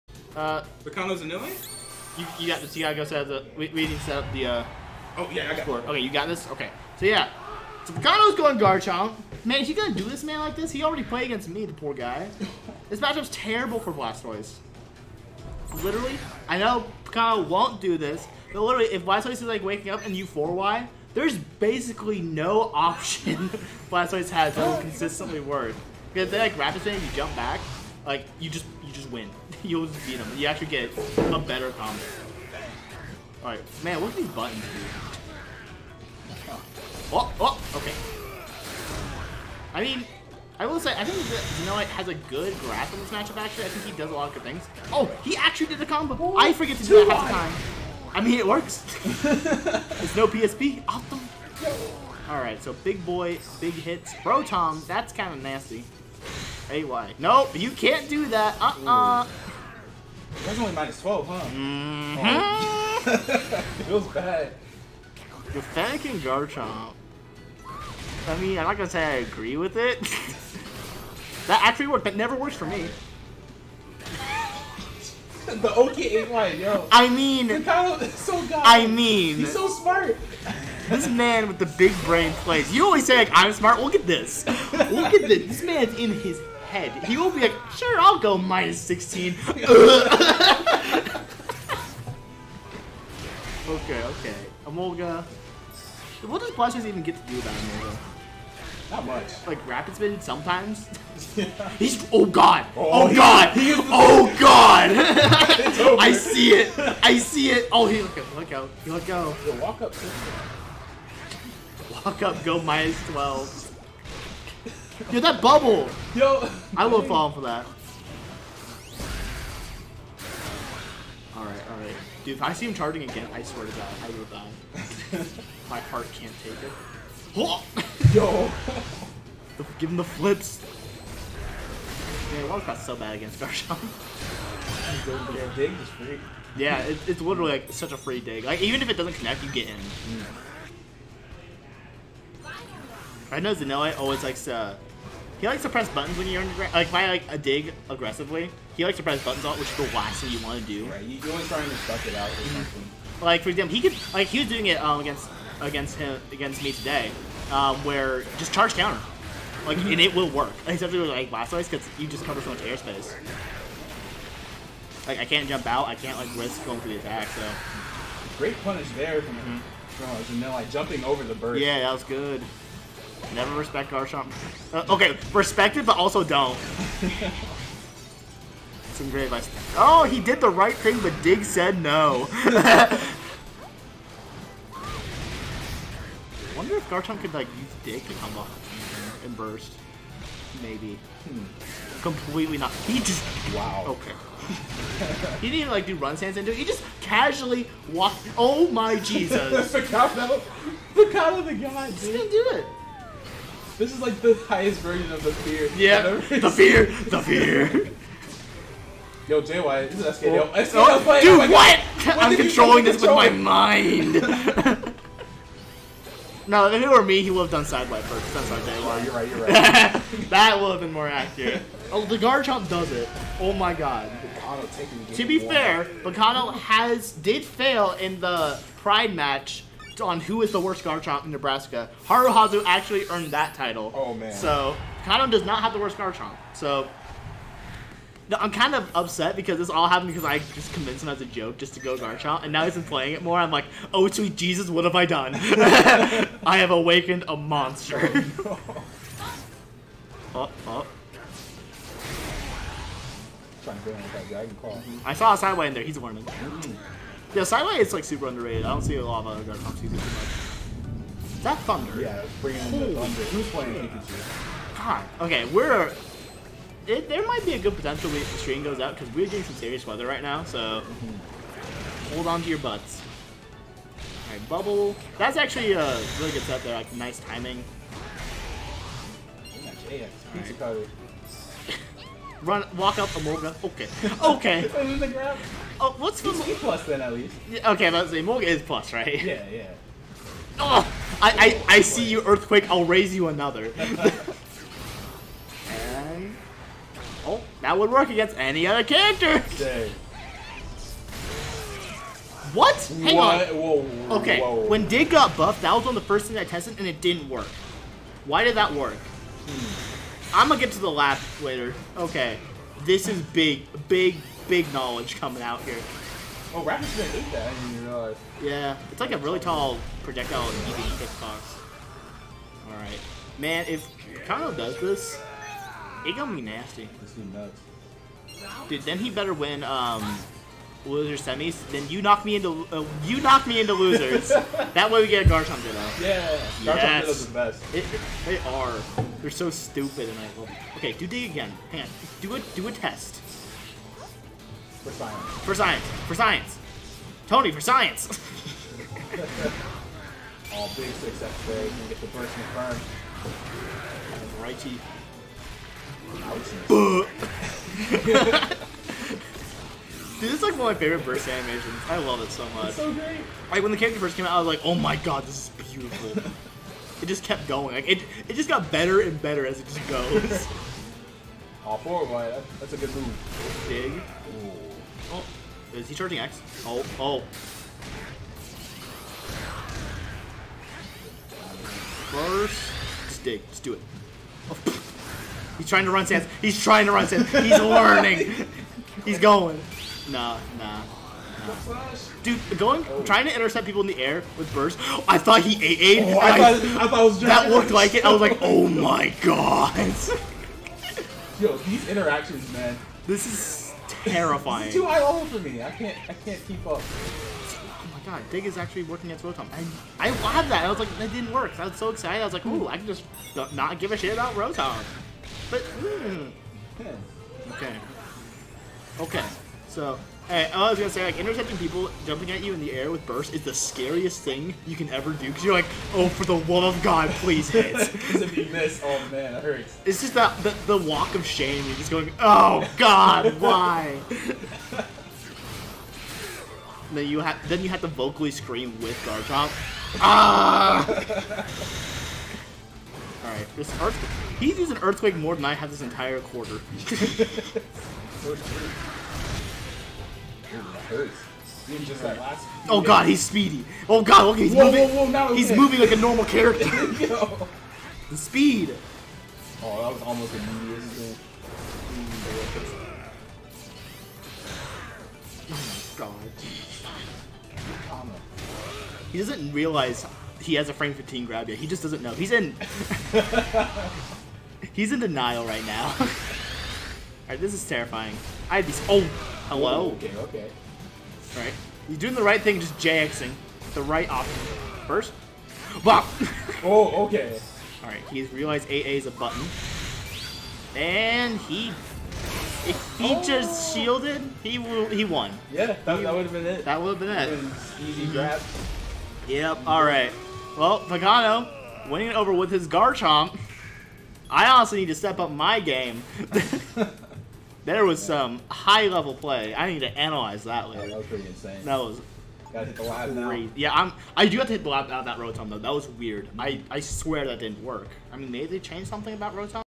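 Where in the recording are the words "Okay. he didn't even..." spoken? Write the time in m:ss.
3:13.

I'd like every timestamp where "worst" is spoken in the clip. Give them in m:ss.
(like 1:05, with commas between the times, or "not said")
3:50, 3:55.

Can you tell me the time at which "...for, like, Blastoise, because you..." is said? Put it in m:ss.
2:40.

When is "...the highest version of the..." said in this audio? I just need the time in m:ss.
3:24.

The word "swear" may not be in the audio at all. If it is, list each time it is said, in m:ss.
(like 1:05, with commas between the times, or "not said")
2:03, 8:36.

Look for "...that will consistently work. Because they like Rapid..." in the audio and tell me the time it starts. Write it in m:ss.
0:24.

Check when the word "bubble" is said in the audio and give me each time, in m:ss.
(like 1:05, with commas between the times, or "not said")
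1:55, 4:34.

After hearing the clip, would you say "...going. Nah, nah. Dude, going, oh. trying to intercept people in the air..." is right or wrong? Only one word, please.
right.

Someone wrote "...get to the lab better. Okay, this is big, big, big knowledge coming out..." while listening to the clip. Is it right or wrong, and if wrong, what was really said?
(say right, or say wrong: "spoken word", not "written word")
wrong: "later", not "better".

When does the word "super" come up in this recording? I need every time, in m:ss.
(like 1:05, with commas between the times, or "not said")
4:18.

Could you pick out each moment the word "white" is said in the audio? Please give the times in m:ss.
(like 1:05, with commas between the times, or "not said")
1:16.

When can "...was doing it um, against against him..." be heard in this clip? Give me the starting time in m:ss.
2:34.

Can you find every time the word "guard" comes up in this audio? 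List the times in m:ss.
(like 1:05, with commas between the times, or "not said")
3:50, 3:55.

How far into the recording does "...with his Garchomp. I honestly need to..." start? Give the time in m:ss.
8:22.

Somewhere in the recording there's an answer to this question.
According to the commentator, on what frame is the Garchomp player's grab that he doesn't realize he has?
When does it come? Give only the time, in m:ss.
7:50.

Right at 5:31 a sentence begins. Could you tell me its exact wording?
Then you knock me into uh, you knock me into losers.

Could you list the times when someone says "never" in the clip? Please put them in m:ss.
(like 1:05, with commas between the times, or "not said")
1:12, 2:53.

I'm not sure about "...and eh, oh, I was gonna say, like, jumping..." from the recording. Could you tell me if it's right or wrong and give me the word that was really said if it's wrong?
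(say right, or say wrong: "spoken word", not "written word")
wrong: "intercepting", not "jumping".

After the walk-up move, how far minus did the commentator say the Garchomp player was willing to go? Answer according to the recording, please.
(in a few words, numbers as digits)
minus 16.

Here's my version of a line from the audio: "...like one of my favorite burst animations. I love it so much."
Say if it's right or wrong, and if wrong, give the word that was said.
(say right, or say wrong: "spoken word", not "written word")
right.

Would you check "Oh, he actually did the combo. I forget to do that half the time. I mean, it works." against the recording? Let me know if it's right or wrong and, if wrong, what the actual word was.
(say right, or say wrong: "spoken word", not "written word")
right.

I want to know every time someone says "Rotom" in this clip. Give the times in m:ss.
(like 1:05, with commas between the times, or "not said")
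6:49, 6:54, 8:35, 8:39.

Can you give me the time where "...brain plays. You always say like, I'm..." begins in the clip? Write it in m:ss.
1:22.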